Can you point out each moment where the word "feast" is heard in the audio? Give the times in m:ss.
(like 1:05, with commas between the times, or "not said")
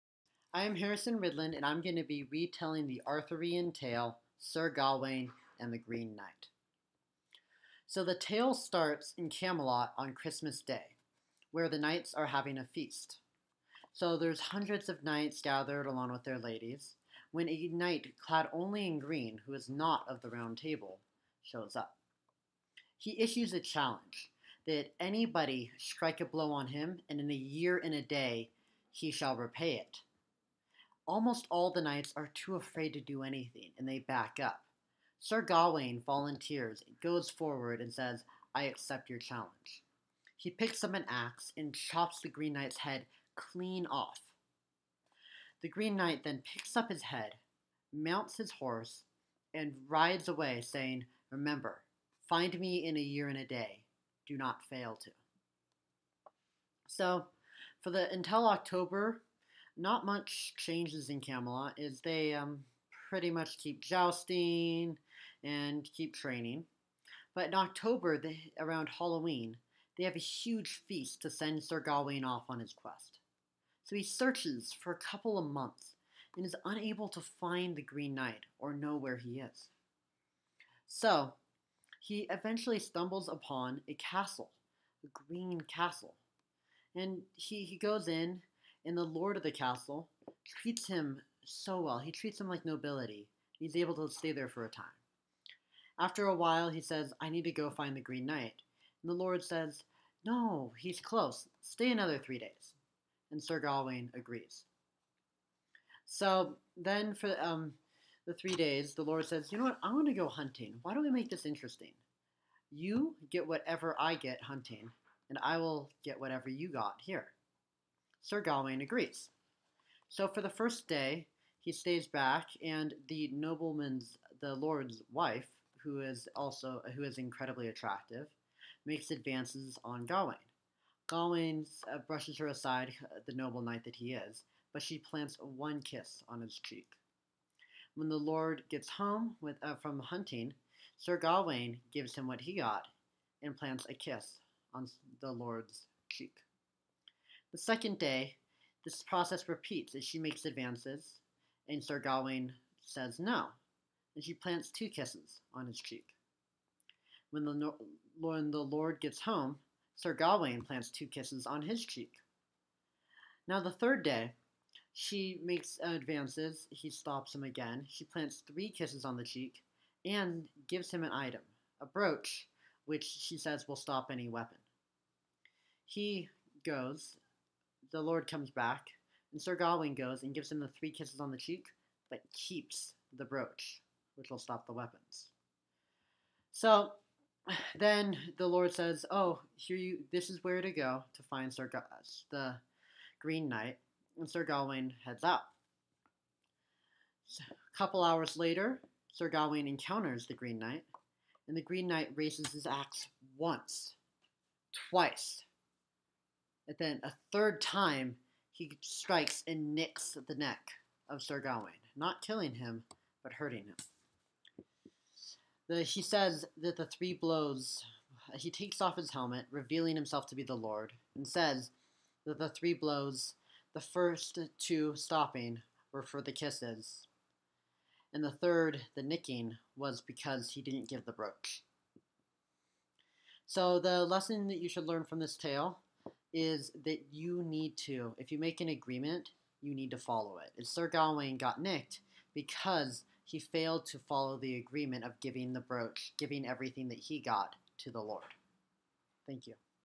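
0:12, 1:10.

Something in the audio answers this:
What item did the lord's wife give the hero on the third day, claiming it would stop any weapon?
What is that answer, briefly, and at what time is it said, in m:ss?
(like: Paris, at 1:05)
a brooch, at 2:51.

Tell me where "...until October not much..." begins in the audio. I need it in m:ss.
0:58.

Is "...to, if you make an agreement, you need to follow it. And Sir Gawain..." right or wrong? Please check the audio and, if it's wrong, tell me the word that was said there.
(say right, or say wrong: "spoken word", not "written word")
right.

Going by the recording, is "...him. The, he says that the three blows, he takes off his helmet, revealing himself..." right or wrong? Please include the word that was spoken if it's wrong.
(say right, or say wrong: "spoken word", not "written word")
right.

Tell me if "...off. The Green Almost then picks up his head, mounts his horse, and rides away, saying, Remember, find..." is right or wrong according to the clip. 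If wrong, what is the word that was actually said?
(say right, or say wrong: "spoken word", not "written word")
wrong: "Knight", not "Almost".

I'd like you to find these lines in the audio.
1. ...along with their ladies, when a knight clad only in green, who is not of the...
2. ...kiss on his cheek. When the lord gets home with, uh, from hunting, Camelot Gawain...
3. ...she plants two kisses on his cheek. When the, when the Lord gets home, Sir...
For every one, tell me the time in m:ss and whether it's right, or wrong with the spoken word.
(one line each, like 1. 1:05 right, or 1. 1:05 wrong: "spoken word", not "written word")
1. 0:15 right
2. 2:15 wrong: "Sir", not "Camelot"
3. 2:34 right.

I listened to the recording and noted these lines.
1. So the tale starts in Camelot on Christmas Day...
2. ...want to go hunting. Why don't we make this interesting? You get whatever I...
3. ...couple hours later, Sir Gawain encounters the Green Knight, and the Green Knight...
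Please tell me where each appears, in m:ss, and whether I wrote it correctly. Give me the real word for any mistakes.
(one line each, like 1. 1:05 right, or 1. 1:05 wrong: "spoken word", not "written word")
1. 0:07 right
2. 1:49 right
3. 3:17 right.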